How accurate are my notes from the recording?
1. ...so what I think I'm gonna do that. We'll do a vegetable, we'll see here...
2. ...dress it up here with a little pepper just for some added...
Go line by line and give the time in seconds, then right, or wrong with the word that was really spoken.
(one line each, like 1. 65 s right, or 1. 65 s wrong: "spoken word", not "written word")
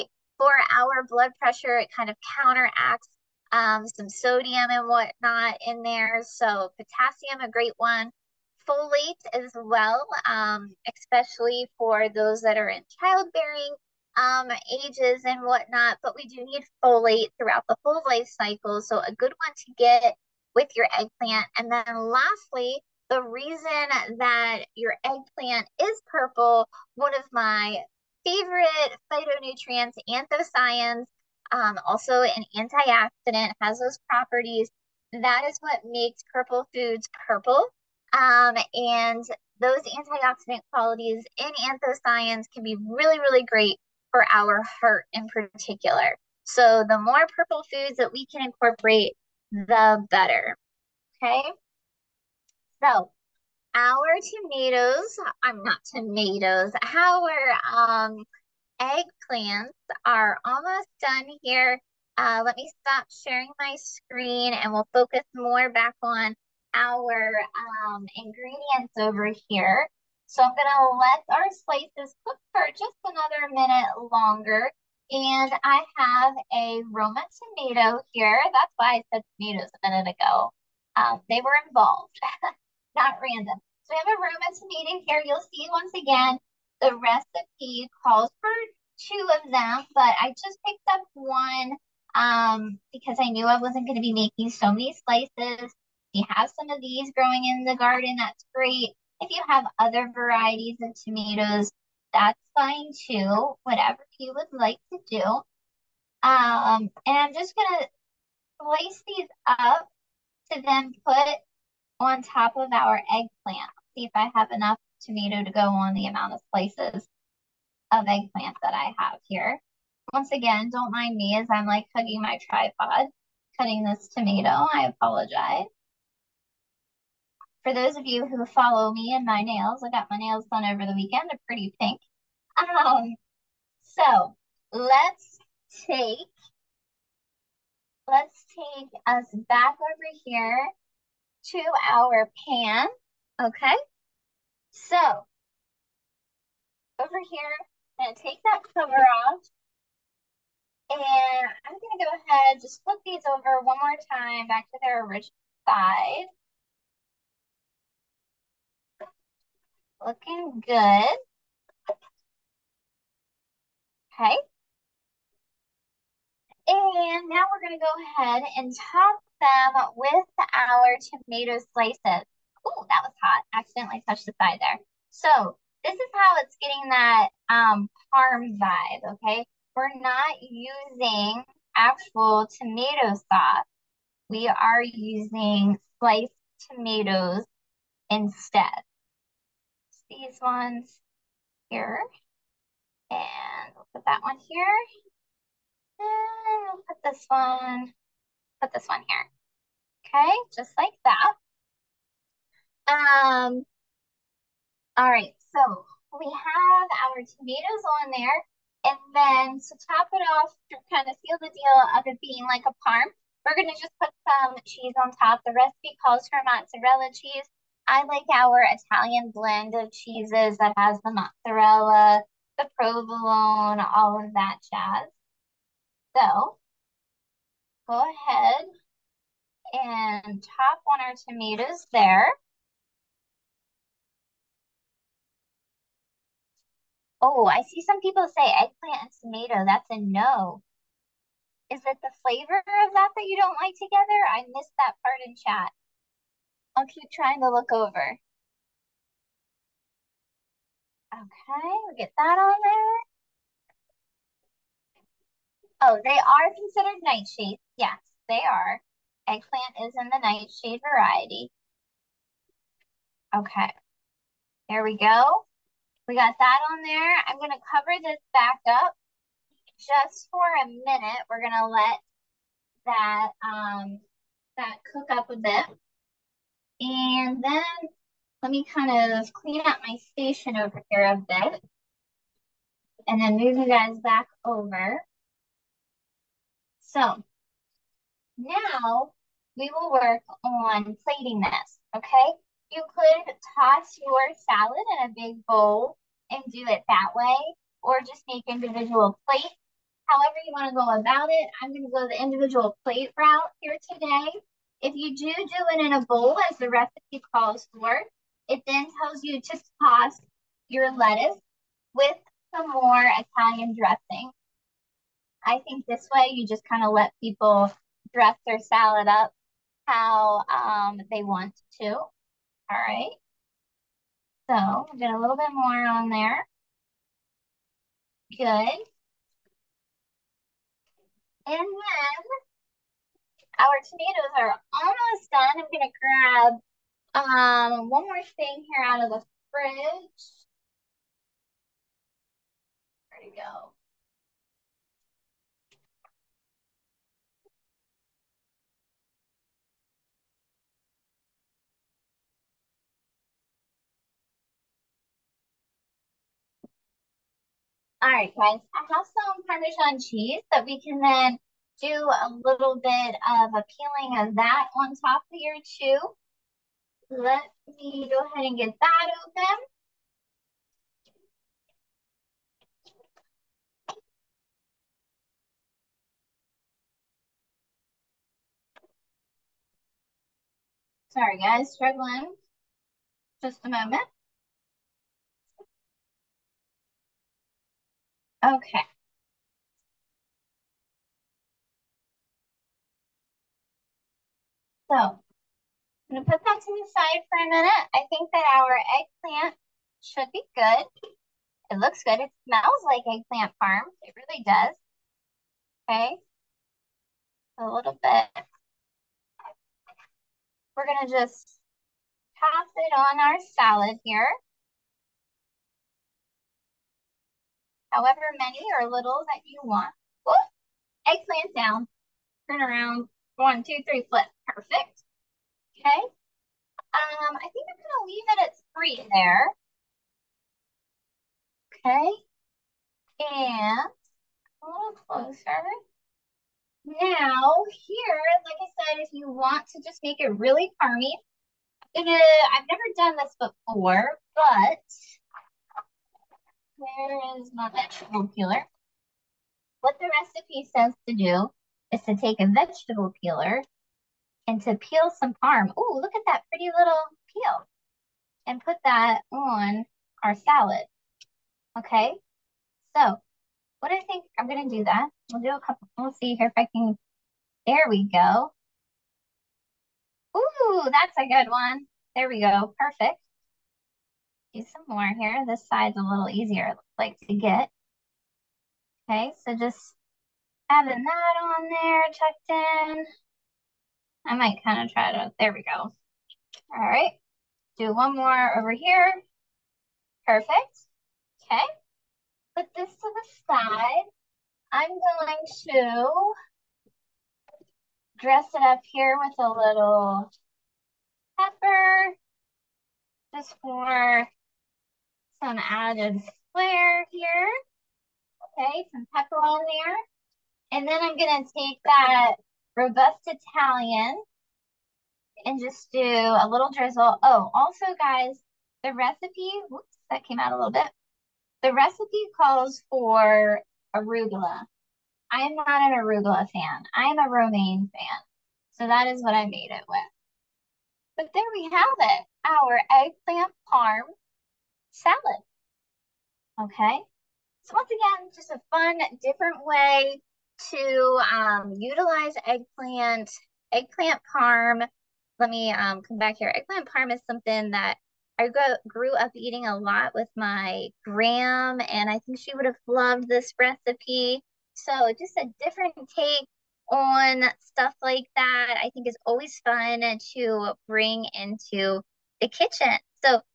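1. 462 s wrong: "couple", not "vegetable"
2. 498 s right.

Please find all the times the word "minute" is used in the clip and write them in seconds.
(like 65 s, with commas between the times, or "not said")
73 s, 79 s, 270 s, 397 s.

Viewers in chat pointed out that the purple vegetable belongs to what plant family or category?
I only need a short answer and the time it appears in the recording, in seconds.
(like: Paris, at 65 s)
nightshades, at 257 s.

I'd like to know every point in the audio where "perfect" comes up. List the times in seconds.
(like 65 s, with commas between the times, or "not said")
424 s, 472 s, 490 s.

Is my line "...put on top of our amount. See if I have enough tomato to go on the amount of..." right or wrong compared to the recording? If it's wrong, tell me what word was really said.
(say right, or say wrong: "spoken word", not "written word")
wrong: "eggplant", not "amount".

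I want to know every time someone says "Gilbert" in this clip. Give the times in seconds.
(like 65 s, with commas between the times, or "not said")
not said.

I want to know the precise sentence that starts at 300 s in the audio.
However you wanna go about it, I'm gonna go the individual plate route here today.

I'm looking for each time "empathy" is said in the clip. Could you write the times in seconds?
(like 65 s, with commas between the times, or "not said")
not said.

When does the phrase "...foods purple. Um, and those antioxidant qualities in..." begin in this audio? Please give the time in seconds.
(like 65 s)
36 s.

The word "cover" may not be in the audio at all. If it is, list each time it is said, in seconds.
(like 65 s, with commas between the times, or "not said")
148 s, 267 s.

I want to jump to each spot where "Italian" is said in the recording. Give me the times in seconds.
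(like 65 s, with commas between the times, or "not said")
218 s, 313 s, 513 s.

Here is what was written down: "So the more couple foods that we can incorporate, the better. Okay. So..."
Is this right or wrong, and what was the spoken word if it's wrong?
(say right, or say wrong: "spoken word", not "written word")
wrong: "purple", not "couple".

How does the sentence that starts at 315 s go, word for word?
I think this way you just kind of let people dress their salad up how um, they want to.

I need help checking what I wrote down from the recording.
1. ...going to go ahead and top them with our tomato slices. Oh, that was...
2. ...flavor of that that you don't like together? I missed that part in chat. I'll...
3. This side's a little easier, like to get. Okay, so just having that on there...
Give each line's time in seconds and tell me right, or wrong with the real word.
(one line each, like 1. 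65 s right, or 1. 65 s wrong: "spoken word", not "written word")
1. 167 s right
2. 242 s right
3. 475 s right.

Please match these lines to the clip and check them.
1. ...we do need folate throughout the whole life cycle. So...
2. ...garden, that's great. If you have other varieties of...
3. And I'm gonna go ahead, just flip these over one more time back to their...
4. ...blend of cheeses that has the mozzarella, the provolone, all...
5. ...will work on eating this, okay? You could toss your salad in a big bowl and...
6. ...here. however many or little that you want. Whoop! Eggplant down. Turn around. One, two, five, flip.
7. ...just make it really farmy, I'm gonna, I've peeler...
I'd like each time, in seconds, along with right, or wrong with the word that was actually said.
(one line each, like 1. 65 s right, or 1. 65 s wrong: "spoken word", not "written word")
1. 16 s right
2. 97 s right
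3. 150 s right
4. 219 s right
5. 289 s wrong: "plating", not "eating"
6. 414 s wrong: "three", not "five"
7. 439 s wrong: "never", not "peeler".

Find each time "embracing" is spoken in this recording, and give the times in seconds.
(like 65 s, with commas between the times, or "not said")
not said.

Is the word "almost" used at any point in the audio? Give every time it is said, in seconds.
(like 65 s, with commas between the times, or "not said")
60 s, 334 s.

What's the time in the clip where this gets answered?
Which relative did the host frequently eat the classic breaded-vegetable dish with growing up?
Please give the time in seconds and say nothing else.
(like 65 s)
551 s.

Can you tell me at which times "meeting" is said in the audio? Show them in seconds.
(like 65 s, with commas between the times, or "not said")
84 s.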